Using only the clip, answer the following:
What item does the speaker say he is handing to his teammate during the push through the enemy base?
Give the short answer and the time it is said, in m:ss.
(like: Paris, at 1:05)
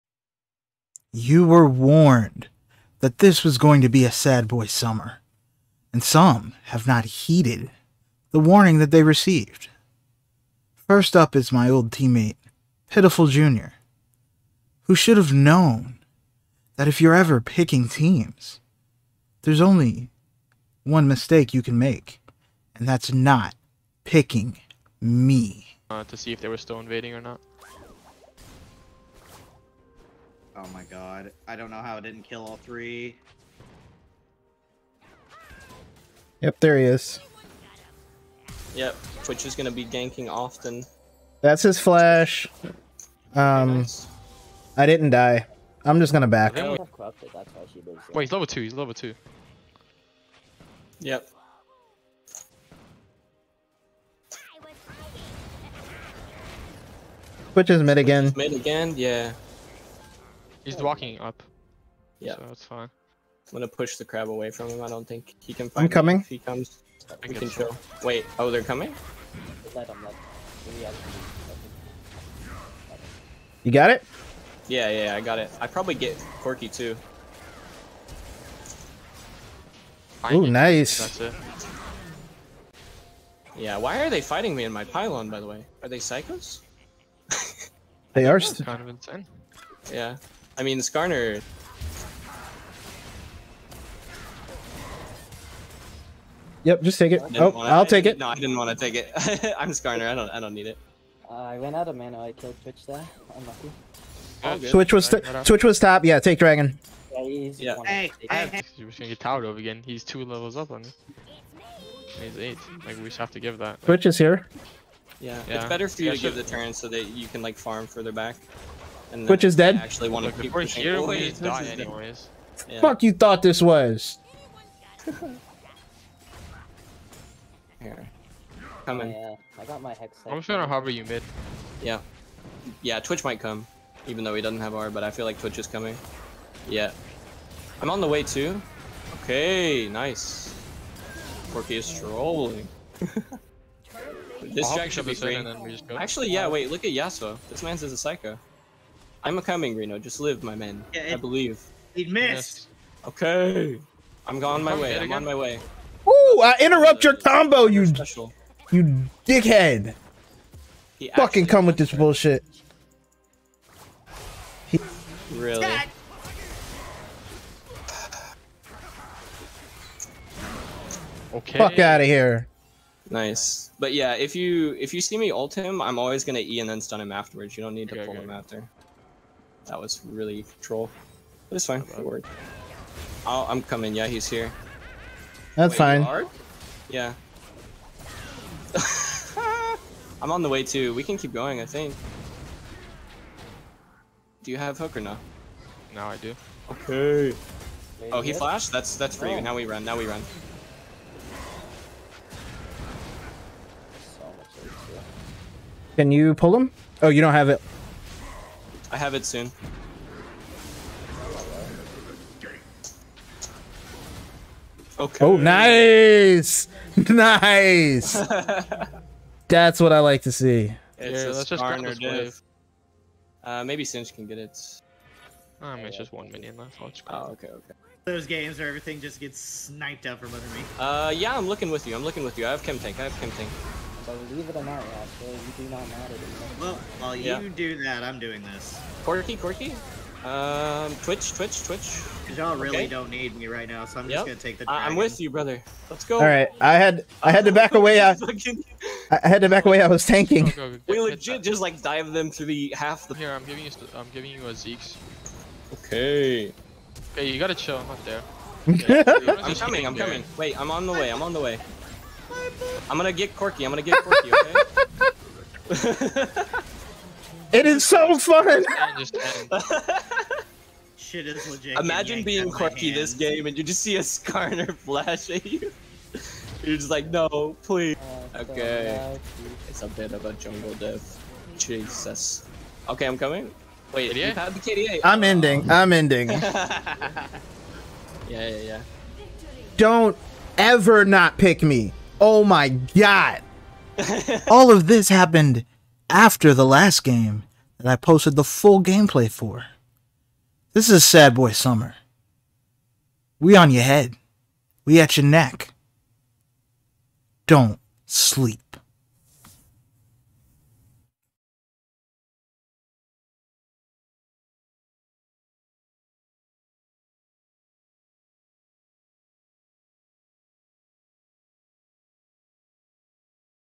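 Zeke's, at 4:14.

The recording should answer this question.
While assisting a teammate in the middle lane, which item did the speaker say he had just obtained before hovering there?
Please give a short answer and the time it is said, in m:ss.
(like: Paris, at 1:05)
Hex, at 2:09.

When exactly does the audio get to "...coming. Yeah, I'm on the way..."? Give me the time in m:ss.
2:15.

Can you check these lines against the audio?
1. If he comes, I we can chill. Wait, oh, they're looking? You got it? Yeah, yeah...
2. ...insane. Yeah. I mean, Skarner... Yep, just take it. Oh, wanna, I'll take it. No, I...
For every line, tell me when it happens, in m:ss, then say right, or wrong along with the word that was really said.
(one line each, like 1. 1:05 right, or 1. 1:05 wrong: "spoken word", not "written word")
1. 1:06 wrong: "coming", not "looking"
2. 1:28 right.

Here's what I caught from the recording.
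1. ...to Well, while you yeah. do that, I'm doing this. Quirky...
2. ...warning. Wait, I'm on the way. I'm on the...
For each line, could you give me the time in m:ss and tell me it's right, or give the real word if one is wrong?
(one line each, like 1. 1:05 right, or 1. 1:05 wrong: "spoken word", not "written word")
1. 3:56 right
2. 4:19 wrong: "coming", not "warning".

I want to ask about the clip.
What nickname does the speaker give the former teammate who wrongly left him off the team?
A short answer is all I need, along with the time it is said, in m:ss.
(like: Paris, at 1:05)
Pitiful Jr., at 0:12.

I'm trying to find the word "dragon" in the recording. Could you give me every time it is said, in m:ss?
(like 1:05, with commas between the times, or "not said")
1:46, 4:04.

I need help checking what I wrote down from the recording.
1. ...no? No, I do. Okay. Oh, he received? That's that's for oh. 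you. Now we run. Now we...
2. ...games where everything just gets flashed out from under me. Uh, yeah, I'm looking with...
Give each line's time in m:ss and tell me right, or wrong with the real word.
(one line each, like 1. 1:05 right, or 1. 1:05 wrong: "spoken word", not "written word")
1. 3:14 wrong: "flashed", not "received"
2. 3:48 wrong: "sniped", not "flashed".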